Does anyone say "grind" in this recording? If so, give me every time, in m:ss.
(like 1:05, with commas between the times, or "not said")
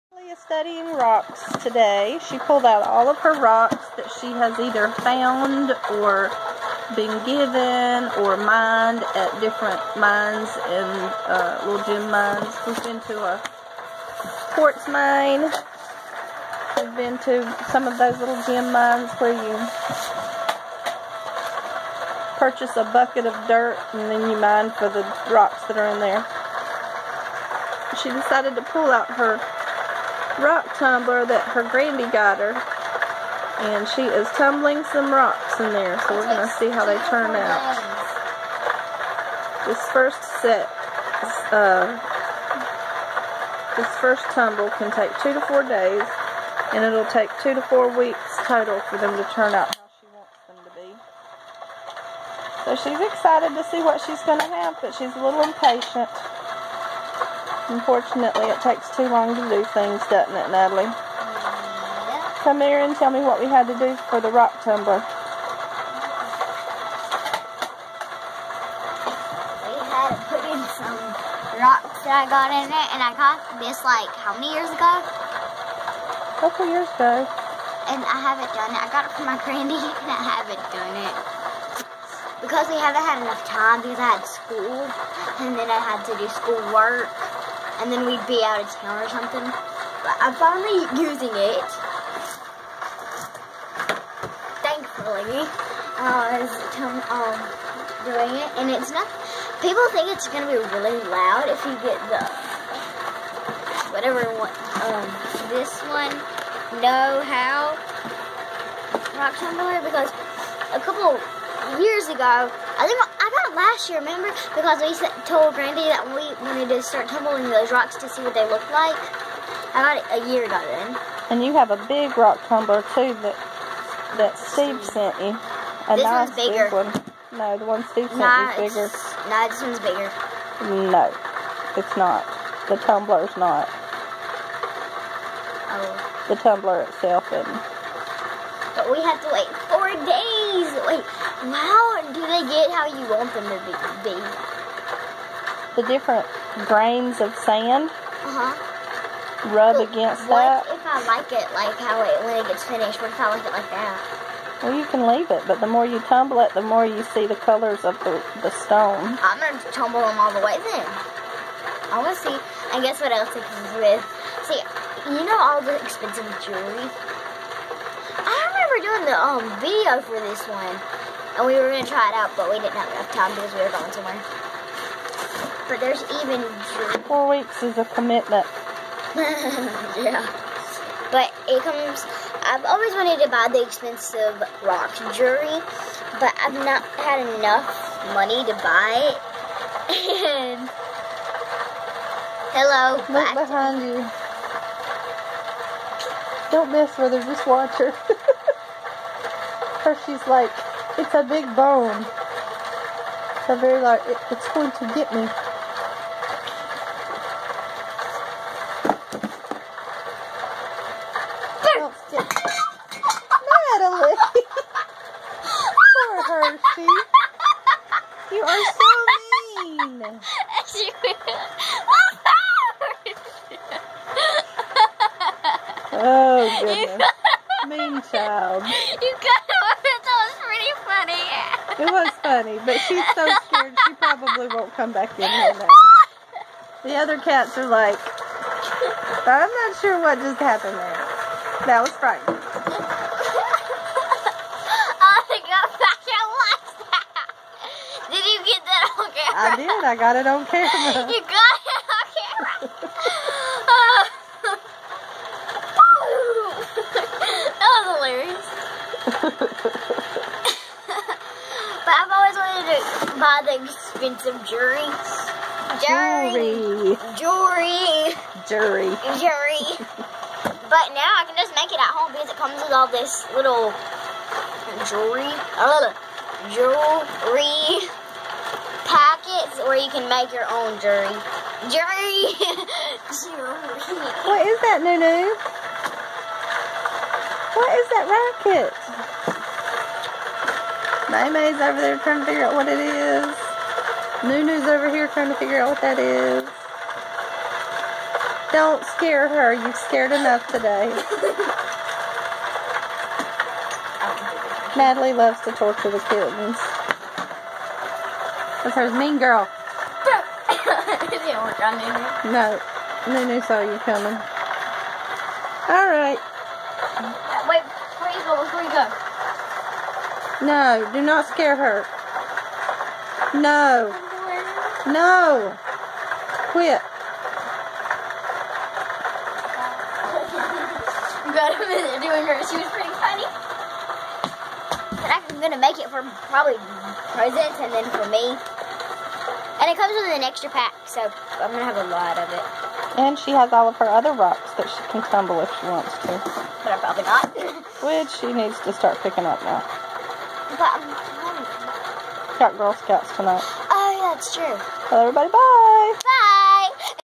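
not said.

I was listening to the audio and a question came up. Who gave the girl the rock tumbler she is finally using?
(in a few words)
her granny.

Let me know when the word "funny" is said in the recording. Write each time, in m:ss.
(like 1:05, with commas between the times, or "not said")
3:52, 5:32.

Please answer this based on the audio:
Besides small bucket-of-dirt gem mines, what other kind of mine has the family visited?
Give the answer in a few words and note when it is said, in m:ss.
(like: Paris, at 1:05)
quartz mine, at 0:14.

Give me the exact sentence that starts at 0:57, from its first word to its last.
Unfortunately, it takes too long to do things, doesn't it, Natalie?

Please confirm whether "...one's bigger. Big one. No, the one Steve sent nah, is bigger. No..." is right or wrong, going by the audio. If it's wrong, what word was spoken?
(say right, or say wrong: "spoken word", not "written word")
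right.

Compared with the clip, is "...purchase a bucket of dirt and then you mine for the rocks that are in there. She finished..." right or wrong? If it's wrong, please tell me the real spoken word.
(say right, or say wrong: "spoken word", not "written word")
wrong: "decided", not "finished".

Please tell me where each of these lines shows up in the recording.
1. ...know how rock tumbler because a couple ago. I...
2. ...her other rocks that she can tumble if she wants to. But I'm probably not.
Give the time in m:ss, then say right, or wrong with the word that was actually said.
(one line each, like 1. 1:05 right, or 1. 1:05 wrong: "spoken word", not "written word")
1. 1:46 right
2. 5:43 right.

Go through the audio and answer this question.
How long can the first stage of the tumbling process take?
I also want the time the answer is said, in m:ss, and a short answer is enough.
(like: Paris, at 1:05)
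2 to 4 days, at 0:45.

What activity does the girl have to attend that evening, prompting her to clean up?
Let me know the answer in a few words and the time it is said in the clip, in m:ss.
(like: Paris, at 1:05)
Girl Scouts, at 5:52.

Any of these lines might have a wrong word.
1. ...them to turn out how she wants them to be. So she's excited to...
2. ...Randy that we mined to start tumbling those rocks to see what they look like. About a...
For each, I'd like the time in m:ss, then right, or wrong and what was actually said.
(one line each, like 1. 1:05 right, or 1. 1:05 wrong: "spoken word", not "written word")
1. 0:48 right
2. 1:55 wrong: "wanted", not "mined".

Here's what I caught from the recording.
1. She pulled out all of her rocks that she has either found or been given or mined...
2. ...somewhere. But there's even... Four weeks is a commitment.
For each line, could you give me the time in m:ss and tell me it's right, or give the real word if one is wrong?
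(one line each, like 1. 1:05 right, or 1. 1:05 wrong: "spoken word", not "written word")
1. 0:02 right
2. 2:53 right.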